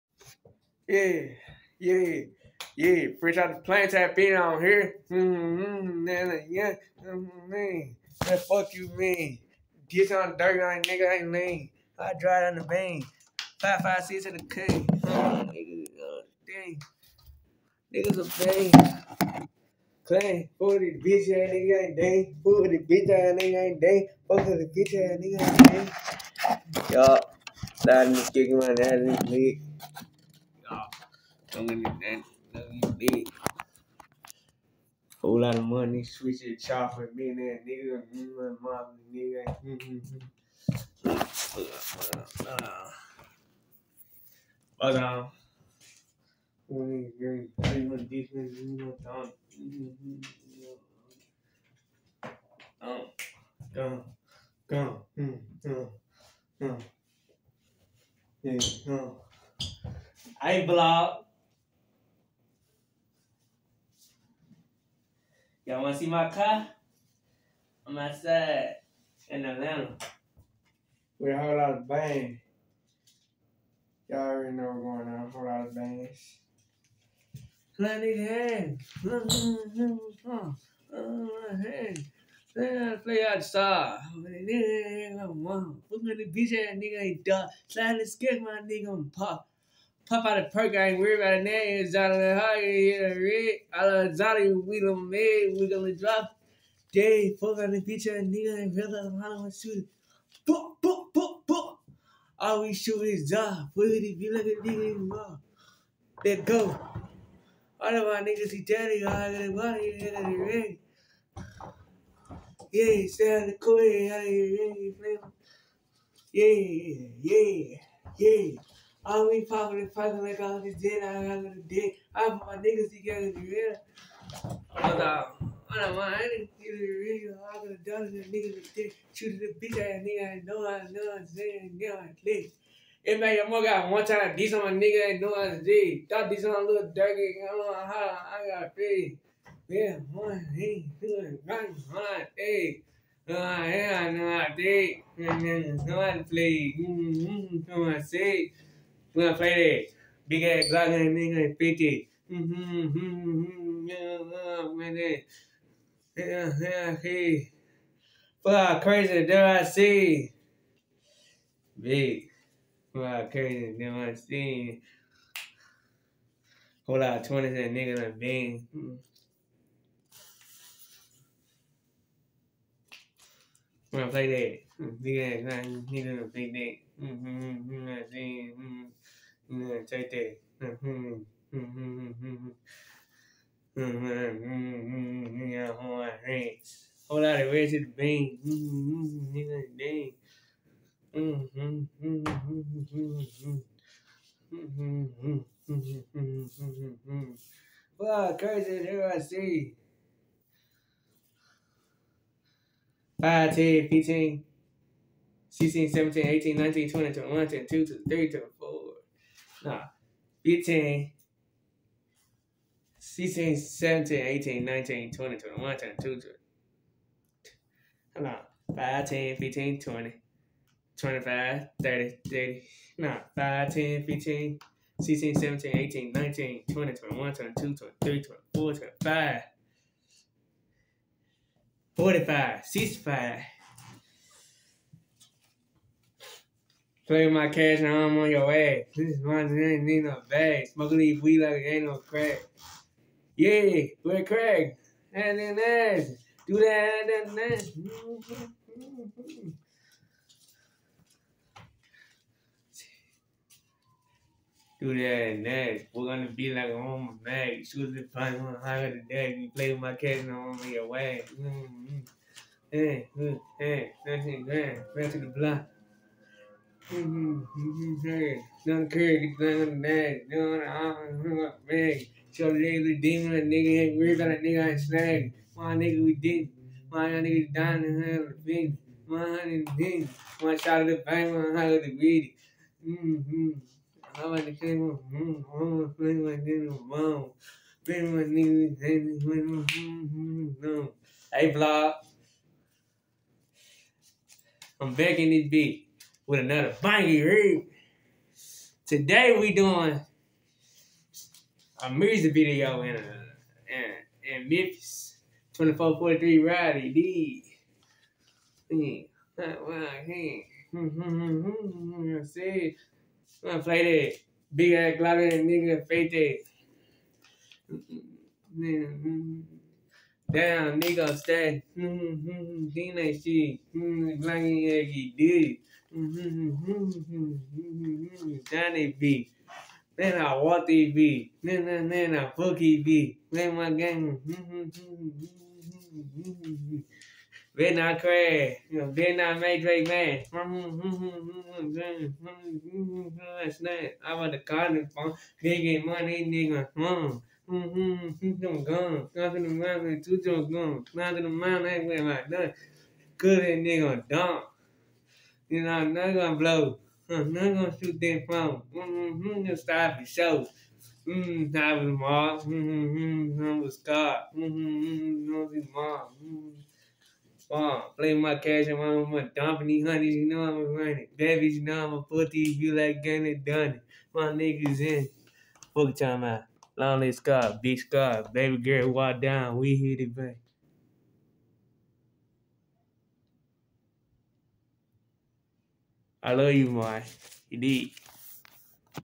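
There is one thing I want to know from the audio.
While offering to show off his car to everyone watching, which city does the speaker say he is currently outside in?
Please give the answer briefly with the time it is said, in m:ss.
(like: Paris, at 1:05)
Atlanta, at 1:09.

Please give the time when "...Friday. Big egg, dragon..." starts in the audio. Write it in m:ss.
2:29.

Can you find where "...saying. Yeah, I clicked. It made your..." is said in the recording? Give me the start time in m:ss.
2:11.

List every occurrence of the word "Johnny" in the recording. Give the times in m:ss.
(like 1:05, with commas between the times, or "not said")
1:34.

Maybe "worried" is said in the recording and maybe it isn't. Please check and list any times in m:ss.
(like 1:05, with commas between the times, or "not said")
1:30, 4:33.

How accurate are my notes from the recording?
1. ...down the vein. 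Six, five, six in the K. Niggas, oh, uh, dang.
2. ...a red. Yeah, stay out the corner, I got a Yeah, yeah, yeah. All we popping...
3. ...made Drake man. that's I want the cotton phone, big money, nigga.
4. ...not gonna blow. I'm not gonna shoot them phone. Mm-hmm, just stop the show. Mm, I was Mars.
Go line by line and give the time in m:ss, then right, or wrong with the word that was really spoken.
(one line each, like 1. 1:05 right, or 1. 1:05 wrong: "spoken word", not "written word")
1. 0:12 wrong: "Five", not "Six"
2. 1:50 right
3. 5:39 right
4. 5:55 right.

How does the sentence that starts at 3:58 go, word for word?
This is mine, it ain't need no bag.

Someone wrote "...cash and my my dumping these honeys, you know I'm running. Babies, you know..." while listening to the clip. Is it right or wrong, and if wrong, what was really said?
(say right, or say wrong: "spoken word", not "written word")
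right.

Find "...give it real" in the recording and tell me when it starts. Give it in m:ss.
2:06.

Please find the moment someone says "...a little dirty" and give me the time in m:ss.
2:16.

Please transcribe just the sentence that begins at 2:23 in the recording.
Uh, yeah, I know I am And then it's not played.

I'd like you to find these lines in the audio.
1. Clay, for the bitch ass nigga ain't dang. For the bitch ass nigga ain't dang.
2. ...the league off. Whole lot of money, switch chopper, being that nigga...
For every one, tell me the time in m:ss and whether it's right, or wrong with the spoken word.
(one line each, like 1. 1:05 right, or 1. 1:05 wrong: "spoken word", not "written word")
1. 0:20 right
2. 0:29 right.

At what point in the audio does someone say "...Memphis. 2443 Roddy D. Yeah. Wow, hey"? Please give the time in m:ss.
5:04.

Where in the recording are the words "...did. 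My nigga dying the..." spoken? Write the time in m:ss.
4:36.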